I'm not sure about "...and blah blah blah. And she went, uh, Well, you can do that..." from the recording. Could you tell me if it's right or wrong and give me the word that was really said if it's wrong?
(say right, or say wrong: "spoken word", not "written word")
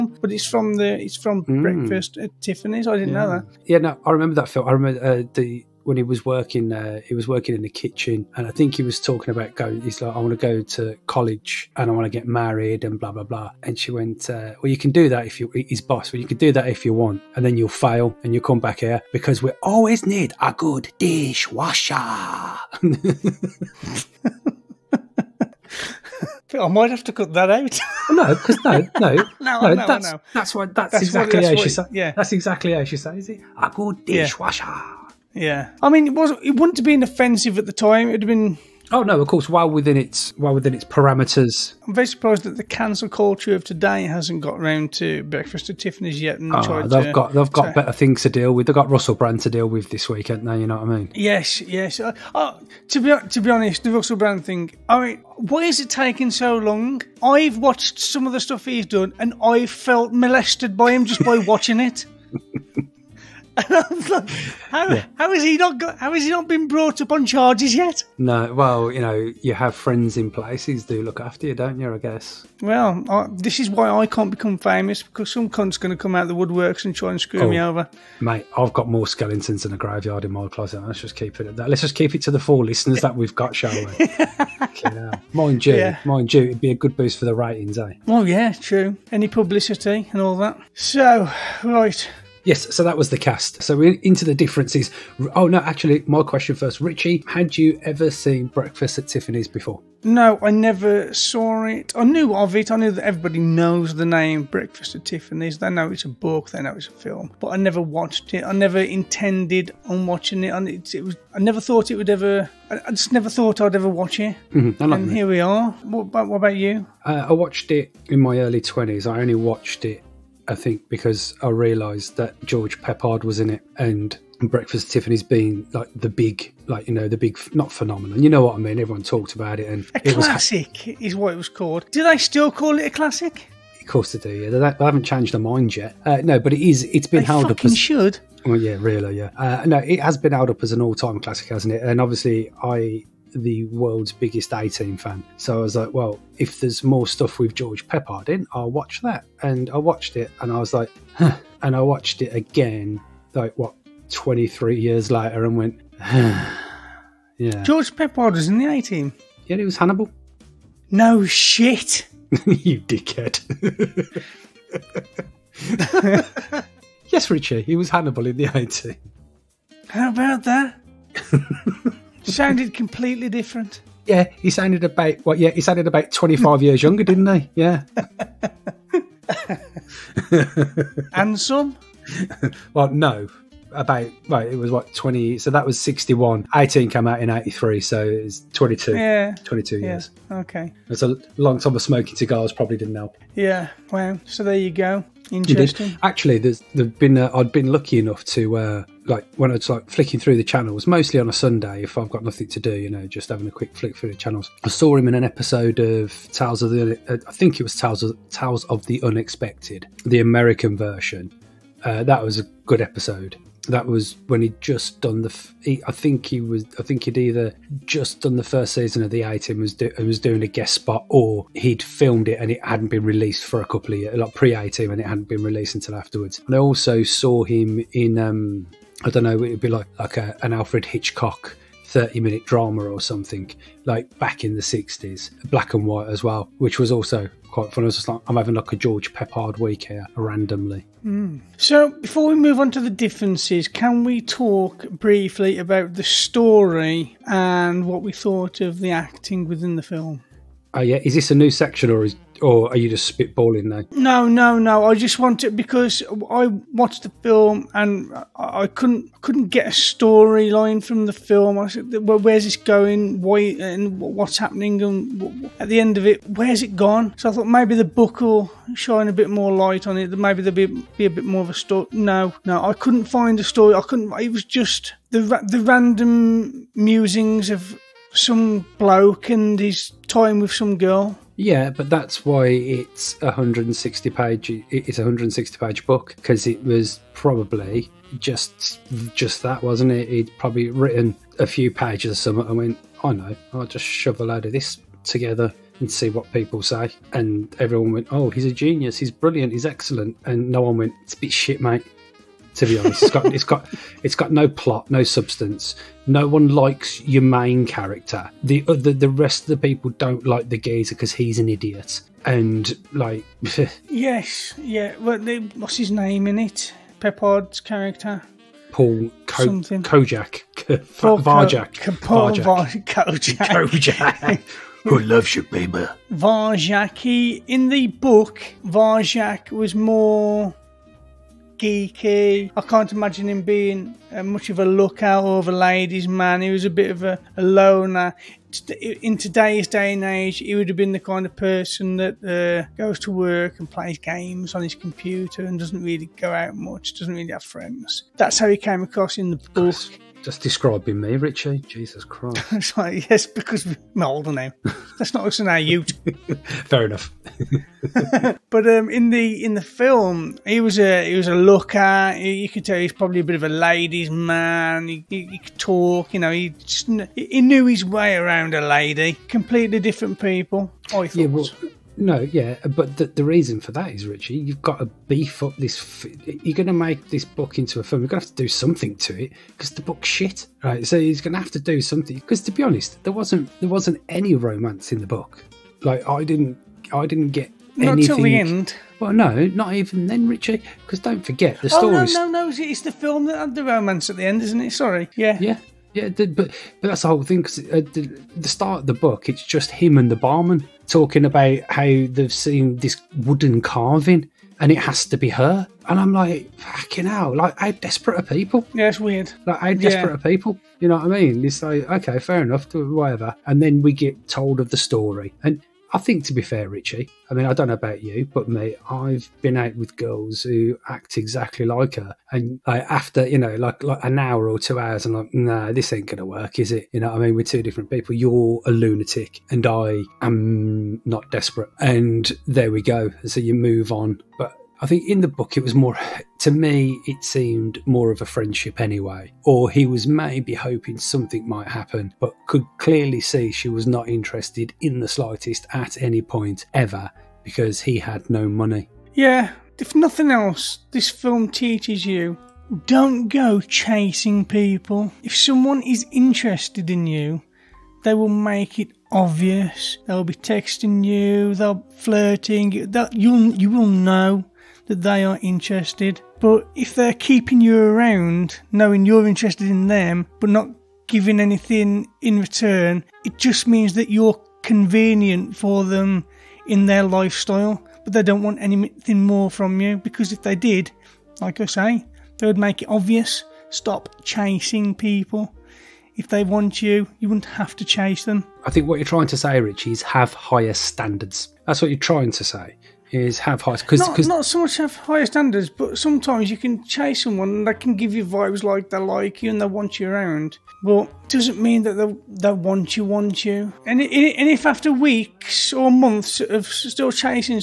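right.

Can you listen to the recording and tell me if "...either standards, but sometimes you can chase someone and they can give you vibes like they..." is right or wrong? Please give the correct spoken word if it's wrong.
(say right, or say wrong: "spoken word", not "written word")
wrong: "higher", not "either".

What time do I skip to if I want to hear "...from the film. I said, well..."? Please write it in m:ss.
4:20.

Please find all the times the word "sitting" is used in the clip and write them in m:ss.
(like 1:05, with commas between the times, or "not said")
not said.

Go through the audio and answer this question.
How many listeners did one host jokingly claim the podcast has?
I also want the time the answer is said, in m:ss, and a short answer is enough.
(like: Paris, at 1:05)
4, at 1:22.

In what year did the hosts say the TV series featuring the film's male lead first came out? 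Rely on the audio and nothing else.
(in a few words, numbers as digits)
1983.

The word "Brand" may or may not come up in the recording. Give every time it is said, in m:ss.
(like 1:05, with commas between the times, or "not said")
0:49, 0:54.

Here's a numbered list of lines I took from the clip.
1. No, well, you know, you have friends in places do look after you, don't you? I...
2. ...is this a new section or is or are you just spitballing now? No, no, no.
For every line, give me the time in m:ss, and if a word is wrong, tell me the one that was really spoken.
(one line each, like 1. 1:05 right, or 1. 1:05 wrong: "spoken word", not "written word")
1. 1:08 right
2. 4:11 right.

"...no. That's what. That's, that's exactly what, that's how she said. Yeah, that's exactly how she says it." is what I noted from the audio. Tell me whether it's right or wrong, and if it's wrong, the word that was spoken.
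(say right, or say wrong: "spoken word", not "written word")
right.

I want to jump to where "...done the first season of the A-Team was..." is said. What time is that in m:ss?
3:38.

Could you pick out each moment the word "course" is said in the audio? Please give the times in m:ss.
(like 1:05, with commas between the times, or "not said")
0:39, 2:13.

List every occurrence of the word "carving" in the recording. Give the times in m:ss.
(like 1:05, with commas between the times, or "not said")
6:43.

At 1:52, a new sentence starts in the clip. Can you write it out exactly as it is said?
I, just never thought I'd ever watch it.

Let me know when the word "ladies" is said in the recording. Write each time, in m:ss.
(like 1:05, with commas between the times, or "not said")
5:35, 6:03.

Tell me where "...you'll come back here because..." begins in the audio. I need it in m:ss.
0:18.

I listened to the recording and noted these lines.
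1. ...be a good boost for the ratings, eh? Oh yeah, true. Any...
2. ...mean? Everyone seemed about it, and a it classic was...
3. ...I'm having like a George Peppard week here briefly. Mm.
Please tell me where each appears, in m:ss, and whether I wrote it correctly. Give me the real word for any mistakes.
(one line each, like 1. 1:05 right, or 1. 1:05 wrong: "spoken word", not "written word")
1. 1:26 right
2. 2:08 wrong: "talked", not "seemed"
3. 3:58 wrong: "randomly", not "briefly".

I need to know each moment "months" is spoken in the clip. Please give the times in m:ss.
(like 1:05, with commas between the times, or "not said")
8:25.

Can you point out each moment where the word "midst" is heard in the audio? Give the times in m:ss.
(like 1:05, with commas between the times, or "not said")
not said.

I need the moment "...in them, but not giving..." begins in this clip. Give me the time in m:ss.
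7:49.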